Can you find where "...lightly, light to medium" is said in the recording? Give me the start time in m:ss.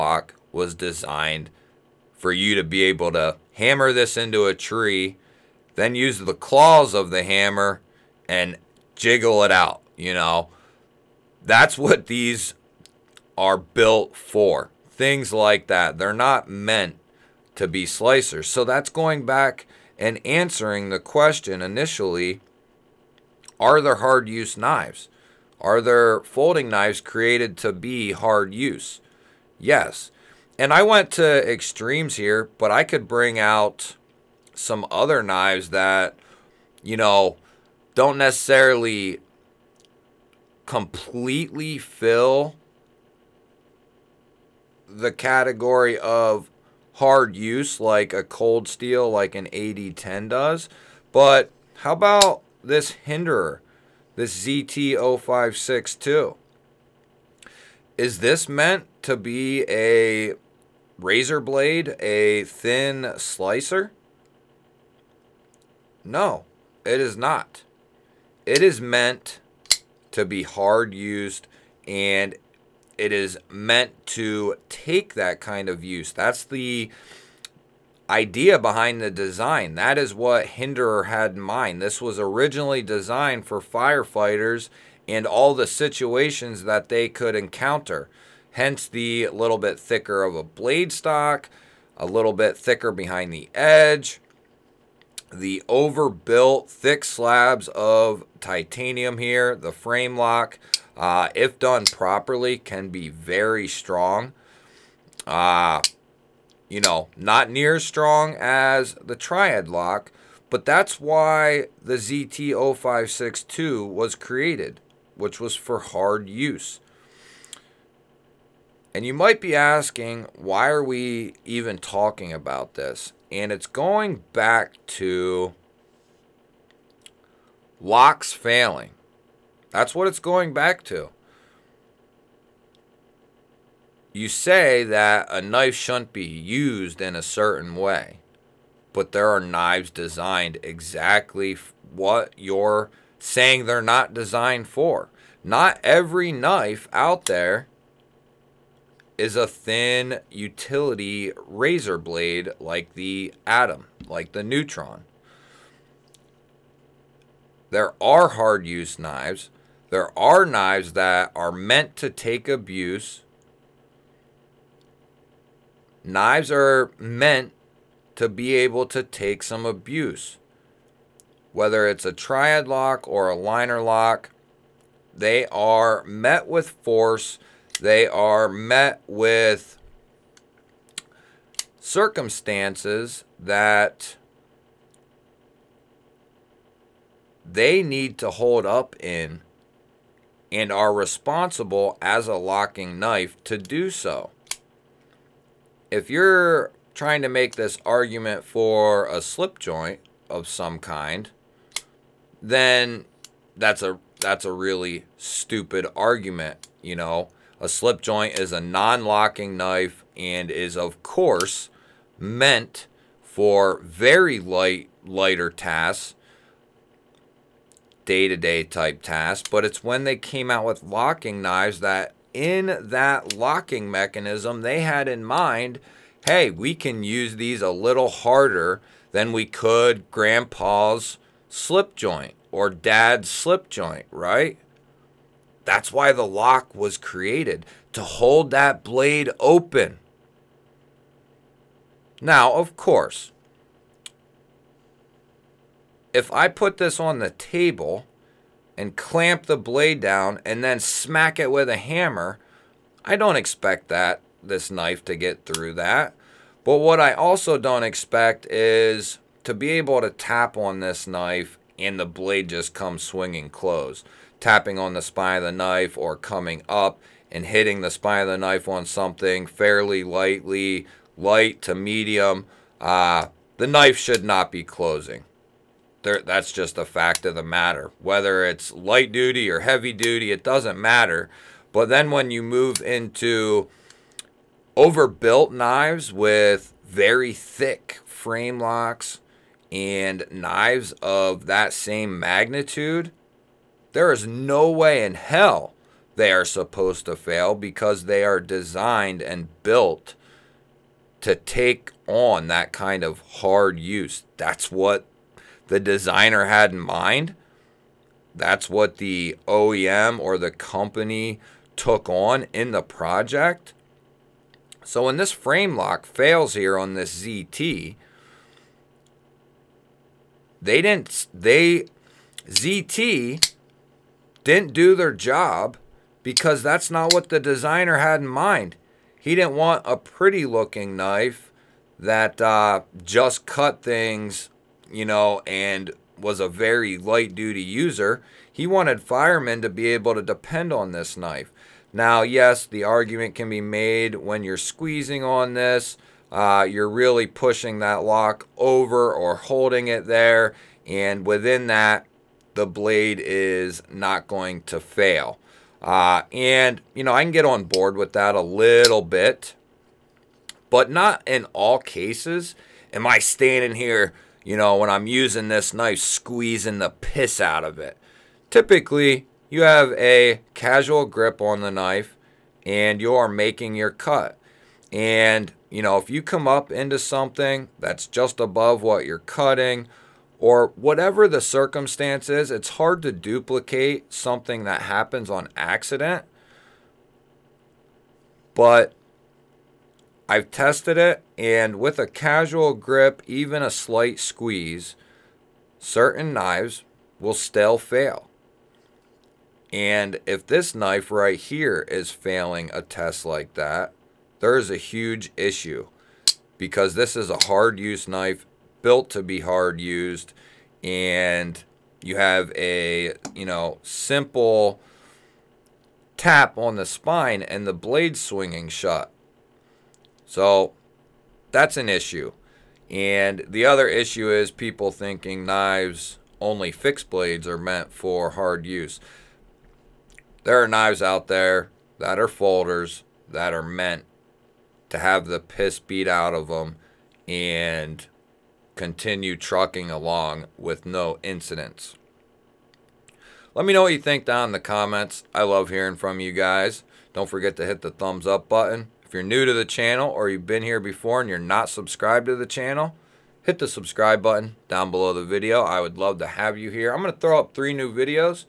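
4:30.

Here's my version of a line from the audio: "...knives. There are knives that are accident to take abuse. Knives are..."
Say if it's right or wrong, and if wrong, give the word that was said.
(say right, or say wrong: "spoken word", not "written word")
wrong: "meant", not "accident".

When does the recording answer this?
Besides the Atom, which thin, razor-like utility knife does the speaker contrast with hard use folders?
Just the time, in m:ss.
2:34.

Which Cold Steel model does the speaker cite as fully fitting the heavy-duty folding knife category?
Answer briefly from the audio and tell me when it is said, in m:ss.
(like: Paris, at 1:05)
AD10, at 0:49.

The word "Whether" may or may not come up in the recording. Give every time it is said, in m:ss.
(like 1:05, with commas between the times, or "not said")
2:51, 4:37.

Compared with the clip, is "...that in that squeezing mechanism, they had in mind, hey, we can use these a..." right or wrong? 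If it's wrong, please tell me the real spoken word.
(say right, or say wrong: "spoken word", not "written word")
wrong: "locking", not "squeezing".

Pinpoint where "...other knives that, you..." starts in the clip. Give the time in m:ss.
0:34.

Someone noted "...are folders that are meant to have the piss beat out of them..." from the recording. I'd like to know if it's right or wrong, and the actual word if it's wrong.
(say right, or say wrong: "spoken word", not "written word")
right.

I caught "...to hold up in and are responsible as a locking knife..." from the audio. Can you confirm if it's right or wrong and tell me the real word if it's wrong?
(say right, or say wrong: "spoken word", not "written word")
right.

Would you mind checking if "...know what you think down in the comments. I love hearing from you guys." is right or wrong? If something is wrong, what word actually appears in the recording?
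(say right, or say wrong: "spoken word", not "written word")
right.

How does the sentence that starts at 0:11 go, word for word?
That's what these are built for.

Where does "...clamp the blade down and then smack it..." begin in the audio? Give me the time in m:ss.
4:08.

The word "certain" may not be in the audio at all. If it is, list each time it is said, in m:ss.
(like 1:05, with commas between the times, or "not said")
2:17, 6:35.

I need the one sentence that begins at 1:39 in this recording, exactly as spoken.
The frame lock, uh, if done properly, can be very strong.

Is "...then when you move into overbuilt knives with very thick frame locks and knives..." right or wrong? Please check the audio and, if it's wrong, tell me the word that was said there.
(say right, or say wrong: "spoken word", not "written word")
right.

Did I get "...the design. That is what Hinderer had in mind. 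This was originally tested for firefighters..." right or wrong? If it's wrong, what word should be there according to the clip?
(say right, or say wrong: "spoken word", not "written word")
wrong: "designed", not "tested".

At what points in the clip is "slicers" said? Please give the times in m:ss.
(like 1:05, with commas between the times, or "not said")
0:17, 1:03.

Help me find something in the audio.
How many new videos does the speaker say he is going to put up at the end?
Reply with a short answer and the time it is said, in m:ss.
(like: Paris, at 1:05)
3, at 7:37.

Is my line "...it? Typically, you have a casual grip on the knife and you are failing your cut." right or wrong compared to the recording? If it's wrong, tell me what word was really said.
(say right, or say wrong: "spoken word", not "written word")
wrong: "making", not "failing".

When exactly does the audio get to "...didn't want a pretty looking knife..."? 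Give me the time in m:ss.
5:29.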